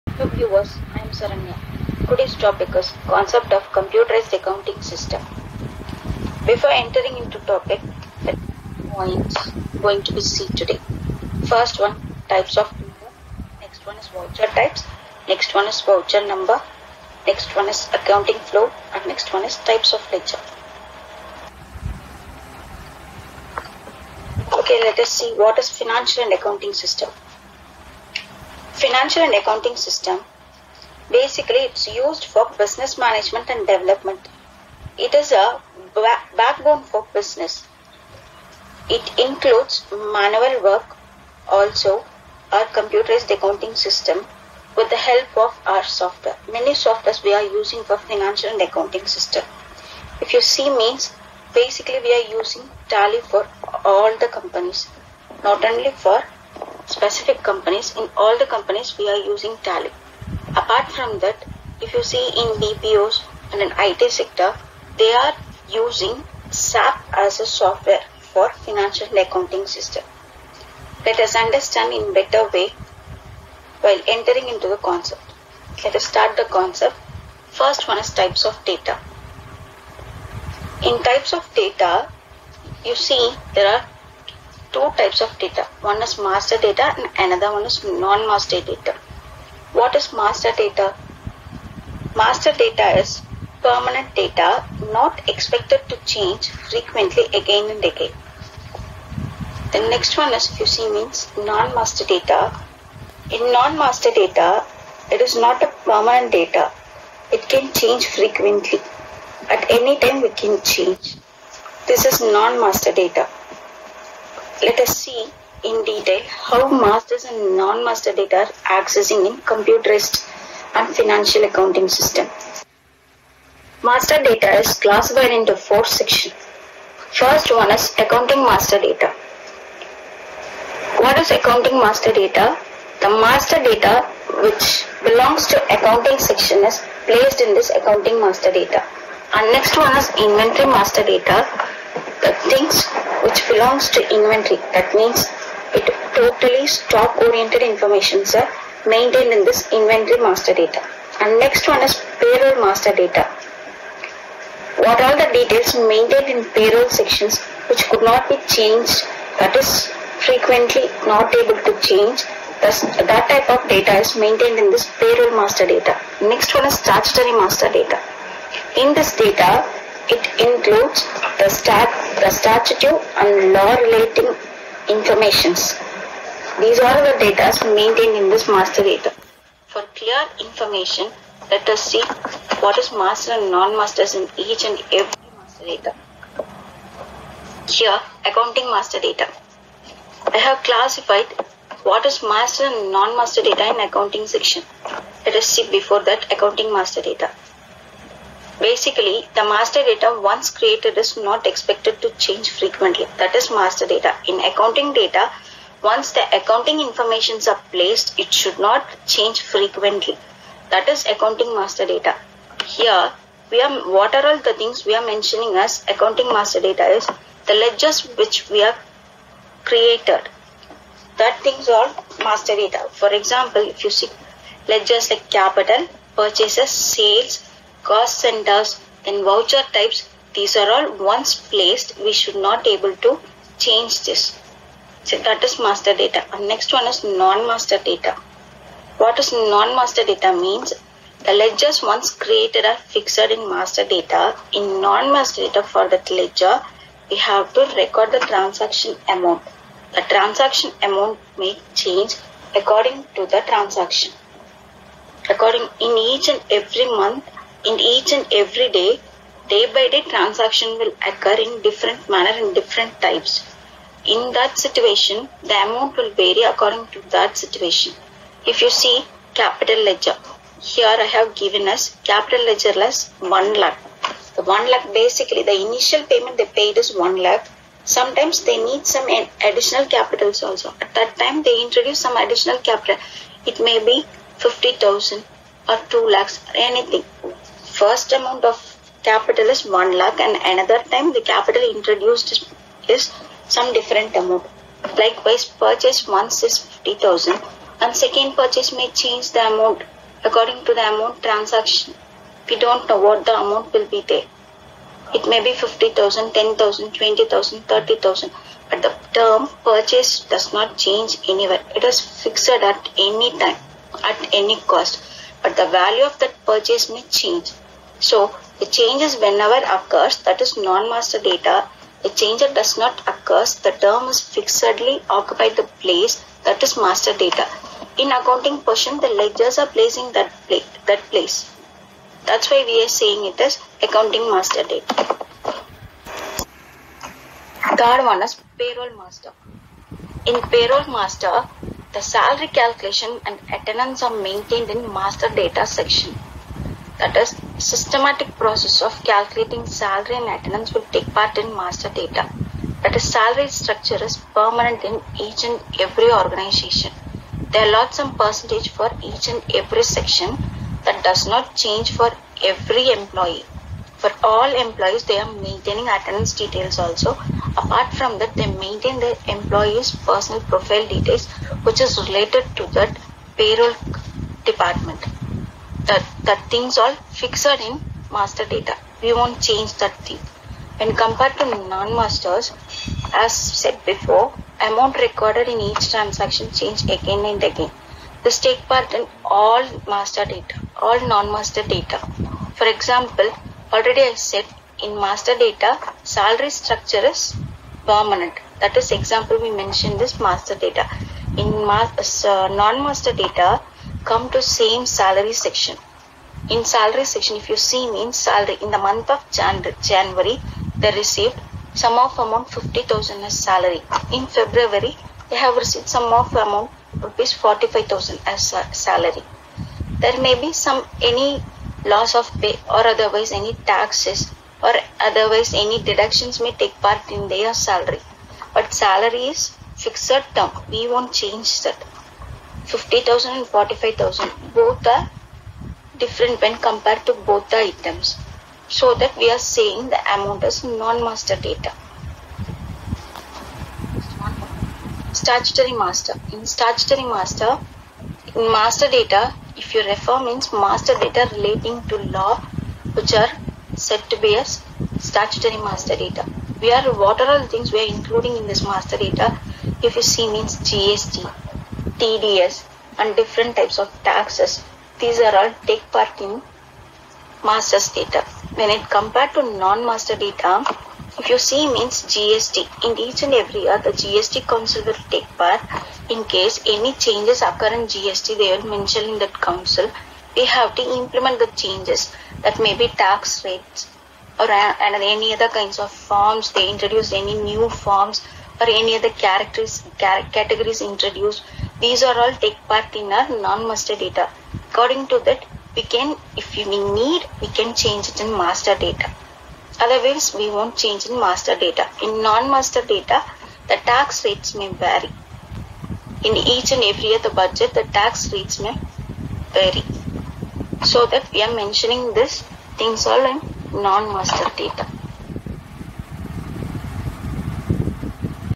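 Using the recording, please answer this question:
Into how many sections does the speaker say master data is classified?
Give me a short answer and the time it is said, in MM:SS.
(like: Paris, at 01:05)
4, at 02:05.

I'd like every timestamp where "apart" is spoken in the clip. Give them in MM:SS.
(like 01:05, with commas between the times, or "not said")
01:00, 06:07.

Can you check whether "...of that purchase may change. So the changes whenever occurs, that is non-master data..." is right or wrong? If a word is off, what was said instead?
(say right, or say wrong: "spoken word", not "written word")
right.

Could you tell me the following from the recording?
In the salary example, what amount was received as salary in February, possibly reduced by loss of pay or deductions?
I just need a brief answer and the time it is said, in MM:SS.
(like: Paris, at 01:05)
45,000, at 06:56.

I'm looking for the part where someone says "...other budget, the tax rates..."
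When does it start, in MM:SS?
08:27.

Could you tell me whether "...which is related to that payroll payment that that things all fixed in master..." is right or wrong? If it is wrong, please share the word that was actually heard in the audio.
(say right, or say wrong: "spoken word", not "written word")
wrong: "department", not "payment".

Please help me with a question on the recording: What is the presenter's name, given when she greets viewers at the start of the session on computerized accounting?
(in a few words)
Saranya.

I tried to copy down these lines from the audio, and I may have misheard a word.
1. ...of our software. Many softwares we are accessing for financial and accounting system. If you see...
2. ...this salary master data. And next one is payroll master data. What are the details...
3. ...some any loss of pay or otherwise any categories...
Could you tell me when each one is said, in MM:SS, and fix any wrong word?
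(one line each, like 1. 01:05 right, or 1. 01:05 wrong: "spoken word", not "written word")
1. 00:45 wrong: "using", not "accessing"
2. 02:29 wrong: "inventory", not "salary"
3. 07:00 wrong: "taxes", not "categories".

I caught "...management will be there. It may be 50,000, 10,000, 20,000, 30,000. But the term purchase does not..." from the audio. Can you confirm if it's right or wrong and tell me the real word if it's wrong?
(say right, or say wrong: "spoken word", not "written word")
wrong: "amount", not "management".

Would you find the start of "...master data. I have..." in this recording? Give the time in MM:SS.
03:08.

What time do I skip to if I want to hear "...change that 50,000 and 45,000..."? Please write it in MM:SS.
07:11.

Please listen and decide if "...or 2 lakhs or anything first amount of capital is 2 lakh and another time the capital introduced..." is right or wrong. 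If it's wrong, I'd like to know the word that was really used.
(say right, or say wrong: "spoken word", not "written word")
wrong: "1", not "2".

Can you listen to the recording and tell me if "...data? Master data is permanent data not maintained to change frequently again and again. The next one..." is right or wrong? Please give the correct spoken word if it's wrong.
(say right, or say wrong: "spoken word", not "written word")
wrong: "expected", not "maintained".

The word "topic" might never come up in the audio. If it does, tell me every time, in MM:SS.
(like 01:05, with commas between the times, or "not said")
00:02, 00:07.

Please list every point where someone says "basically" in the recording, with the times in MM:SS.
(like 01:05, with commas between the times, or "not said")
00:31, 00:51, 03:18, 04:34.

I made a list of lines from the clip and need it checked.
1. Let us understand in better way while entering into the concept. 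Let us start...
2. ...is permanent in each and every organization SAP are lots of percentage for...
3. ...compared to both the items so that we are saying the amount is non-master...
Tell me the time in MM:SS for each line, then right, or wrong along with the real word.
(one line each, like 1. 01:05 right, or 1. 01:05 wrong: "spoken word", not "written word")
1. 01:11 right
2. 05:54 wrong: "There", not "SAP"
3. 07:16 right.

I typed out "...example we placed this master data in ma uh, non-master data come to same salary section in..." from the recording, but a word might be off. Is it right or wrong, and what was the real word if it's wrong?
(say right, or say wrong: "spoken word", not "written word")
wrong: "mentioned", not "placed".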